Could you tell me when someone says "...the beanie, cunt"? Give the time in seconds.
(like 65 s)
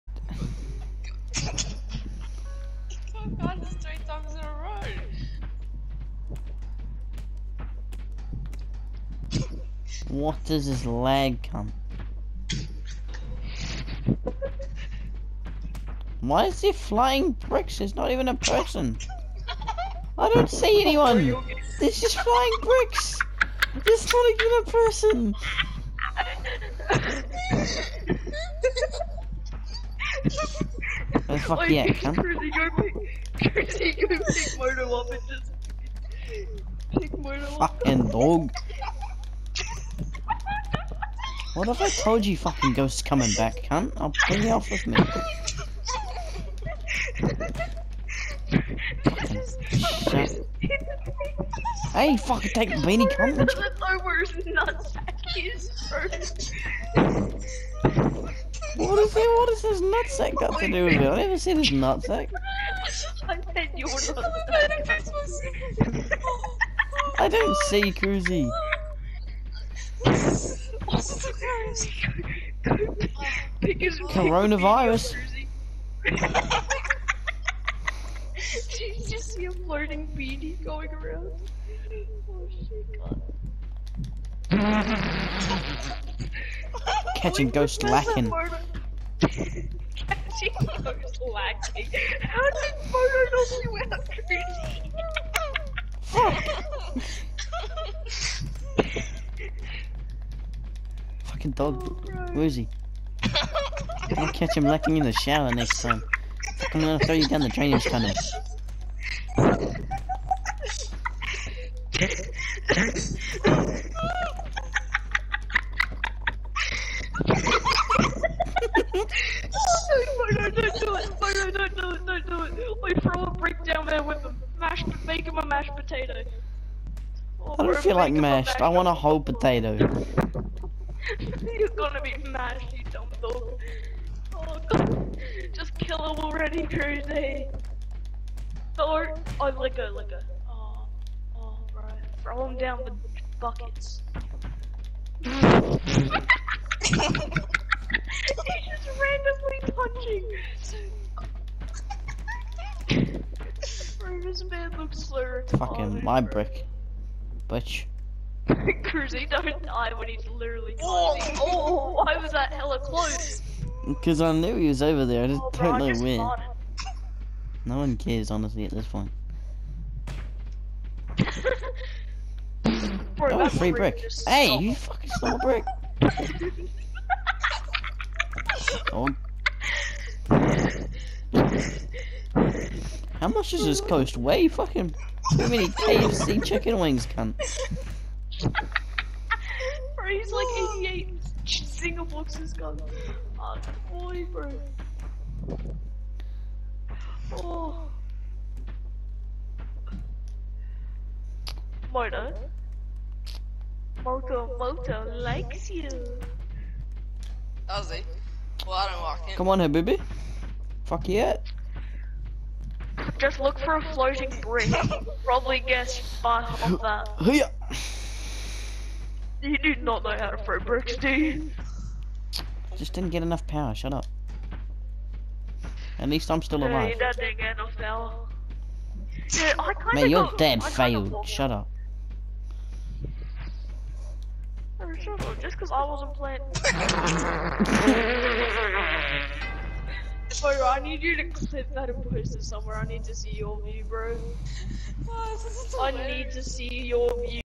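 52 s.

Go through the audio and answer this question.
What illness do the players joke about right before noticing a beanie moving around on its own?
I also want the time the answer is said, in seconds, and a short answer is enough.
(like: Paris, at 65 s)
Coronavirus, at 74 s.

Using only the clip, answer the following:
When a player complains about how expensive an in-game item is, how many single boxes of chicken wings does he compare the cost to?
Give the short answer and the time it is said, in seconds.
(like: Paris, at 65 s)
88, at 190 s.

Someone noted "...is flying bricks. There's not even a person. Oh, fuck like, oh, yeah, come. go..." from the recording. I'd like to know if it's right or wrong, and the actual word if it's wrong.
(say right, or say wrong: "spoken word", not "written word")
right.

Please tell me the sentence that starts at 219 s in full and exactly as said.
You do not know how to throw bricks, do you?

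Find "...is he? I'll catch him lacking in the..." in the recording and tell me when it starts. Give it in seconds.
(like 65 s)
102 s.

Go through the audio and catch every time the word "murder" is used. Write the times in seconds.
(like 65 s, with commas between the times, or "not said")
201 s.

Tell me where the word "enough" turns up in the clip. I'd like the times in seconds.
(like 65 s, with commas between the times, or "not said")
223 s, 227 s.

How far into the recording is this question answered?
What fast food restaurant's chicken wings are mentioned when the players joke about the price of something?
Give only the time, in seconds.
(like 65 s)
185 s.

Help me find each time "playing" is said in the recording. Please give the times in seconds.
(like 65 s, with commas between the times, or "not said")
236 s.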